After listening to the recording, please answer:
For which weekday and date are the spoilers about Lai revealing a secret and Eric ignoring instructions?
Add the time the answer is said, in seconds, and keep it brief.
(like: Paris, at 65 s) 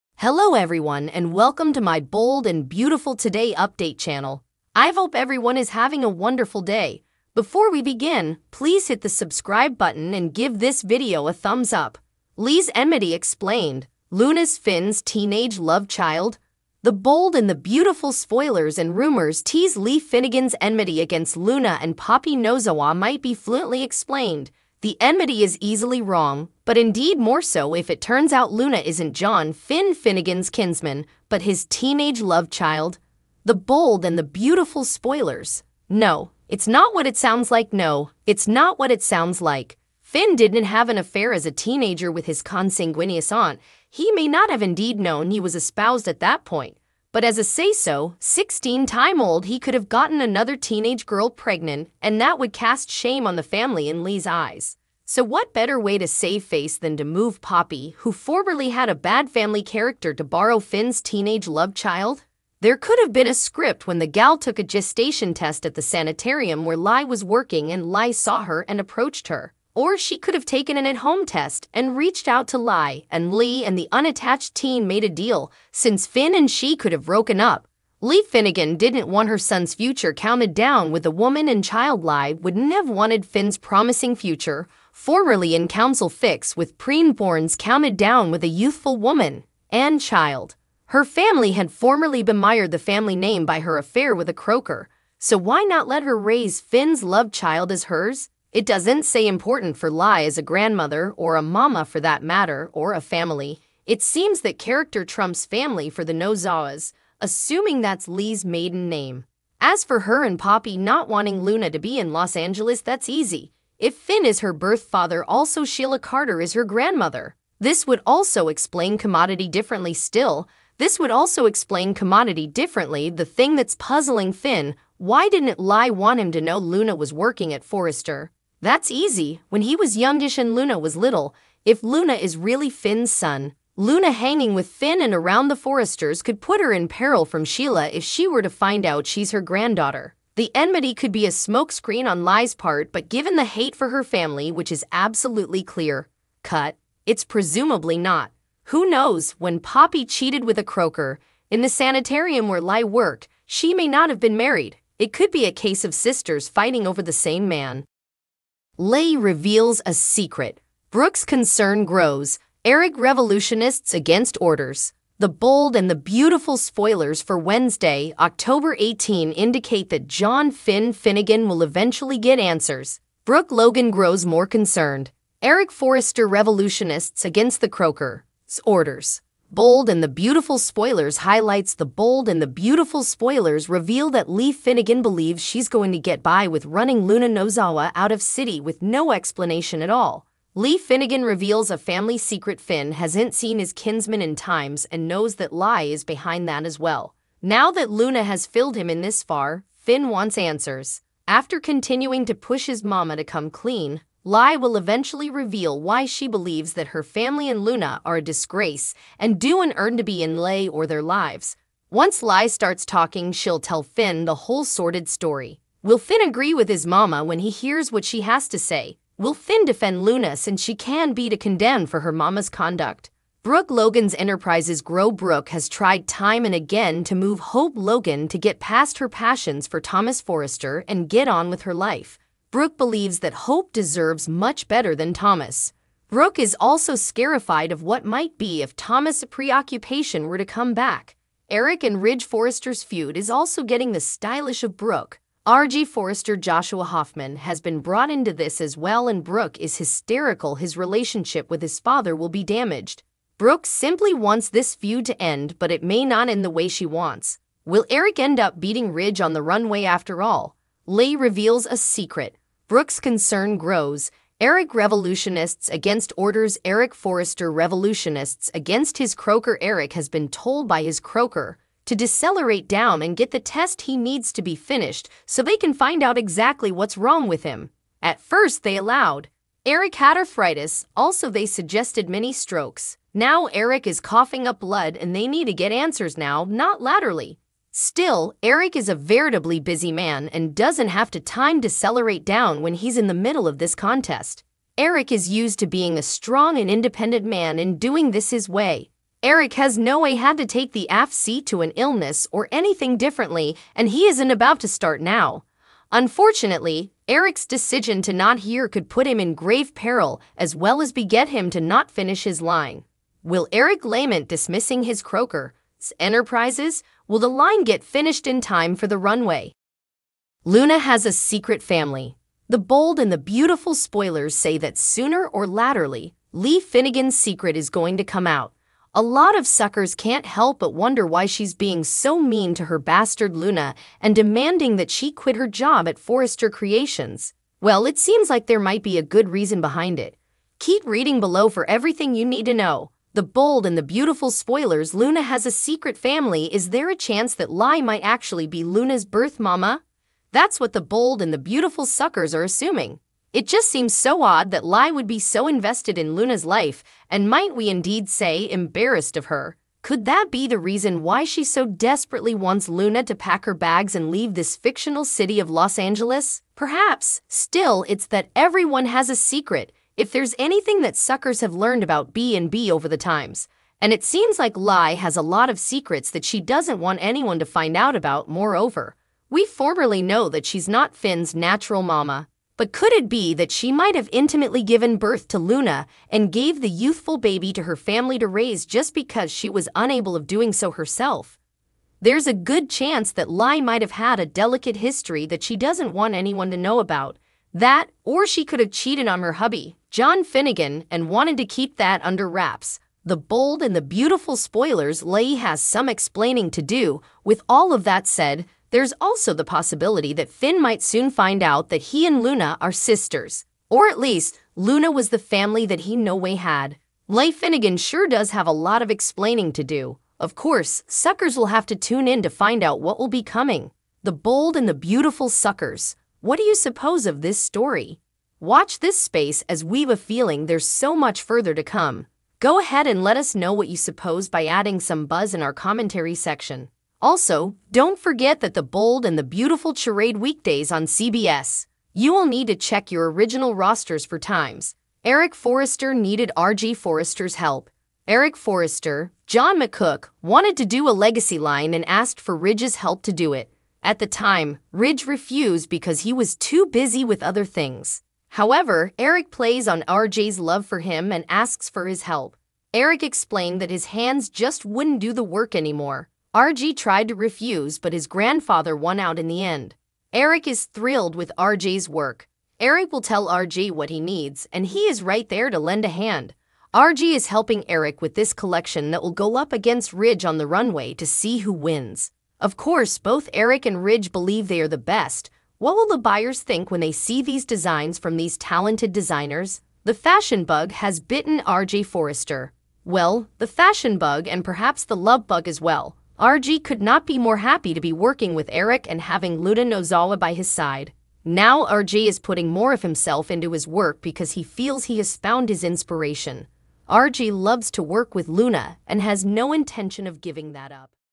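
Wednesday, October 18, at 167 s.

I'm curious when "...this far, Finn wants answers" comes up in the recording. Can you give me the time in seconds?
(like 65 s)
198 s.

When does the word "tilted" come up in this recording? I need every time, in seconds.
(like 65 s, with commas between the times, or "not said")
not said.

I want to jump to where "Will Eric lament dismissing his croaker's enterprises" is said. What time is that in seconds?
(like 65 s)
313 s.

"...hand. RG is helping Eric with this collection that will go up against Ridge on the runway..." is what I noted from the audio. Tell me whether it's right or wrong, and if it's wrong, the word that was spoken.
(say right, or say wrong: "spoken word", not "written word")
right.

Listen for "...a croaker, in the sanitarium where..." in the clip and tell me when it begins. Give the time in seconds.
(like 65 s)
150 s.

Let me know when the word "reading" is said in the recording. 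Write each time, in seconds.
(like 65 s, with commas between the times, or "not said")
340 s.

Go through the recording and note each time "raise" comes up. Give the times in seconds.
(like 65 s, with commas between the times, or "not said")
96 s, 388 s.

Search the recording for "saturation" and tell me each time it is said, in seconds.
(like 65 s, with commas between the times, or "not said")
not said.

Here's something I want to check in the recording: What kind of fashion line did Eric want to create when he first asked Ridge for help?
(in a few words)
legacy line.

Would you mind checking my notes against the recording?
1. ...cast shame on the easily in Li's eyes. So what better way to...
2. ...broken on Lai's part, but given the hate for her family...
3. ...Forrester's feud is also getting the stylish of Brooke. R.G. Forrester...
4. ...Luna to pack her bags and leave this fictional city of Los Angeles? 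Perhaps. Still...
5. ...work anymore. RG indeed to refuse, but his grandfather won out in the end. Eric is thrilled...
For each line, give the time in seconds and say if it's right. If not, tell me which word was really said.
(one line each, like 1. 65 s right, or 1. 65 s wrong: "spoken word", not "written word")
1. 52 s wrong: "family", not "easily"
2. 141 s wrong: "smokescreen", not "broken"
3. 242 s right
4. 362 s right
5. 465 s wrong: "tried", not "indeed".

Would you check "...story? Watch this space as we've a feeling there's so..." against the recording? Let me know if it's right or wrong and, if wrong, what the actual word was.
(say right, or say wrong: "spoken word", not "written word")
right.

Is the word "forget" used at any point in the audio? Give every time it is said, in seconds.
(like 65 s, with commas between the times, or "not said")
437 s.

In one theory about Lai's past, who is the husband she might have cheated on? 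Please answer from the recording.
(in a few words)
John Finnegan.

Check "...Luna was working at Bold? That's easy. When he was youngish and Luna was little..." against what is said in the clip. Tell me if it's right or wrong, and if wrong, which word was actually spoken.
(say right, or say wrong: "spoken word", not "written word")
wrong: "Forrester", not "Bold".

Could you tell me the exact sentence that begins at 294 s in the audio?
Eric is used to being a strong and independent man and doing this his way.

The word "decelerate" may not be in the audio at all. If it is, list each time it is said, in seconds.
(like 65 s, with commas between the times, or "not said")
271 s, 291 s.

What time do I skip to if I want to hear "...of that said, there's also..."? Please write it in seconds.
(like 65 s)
407 s.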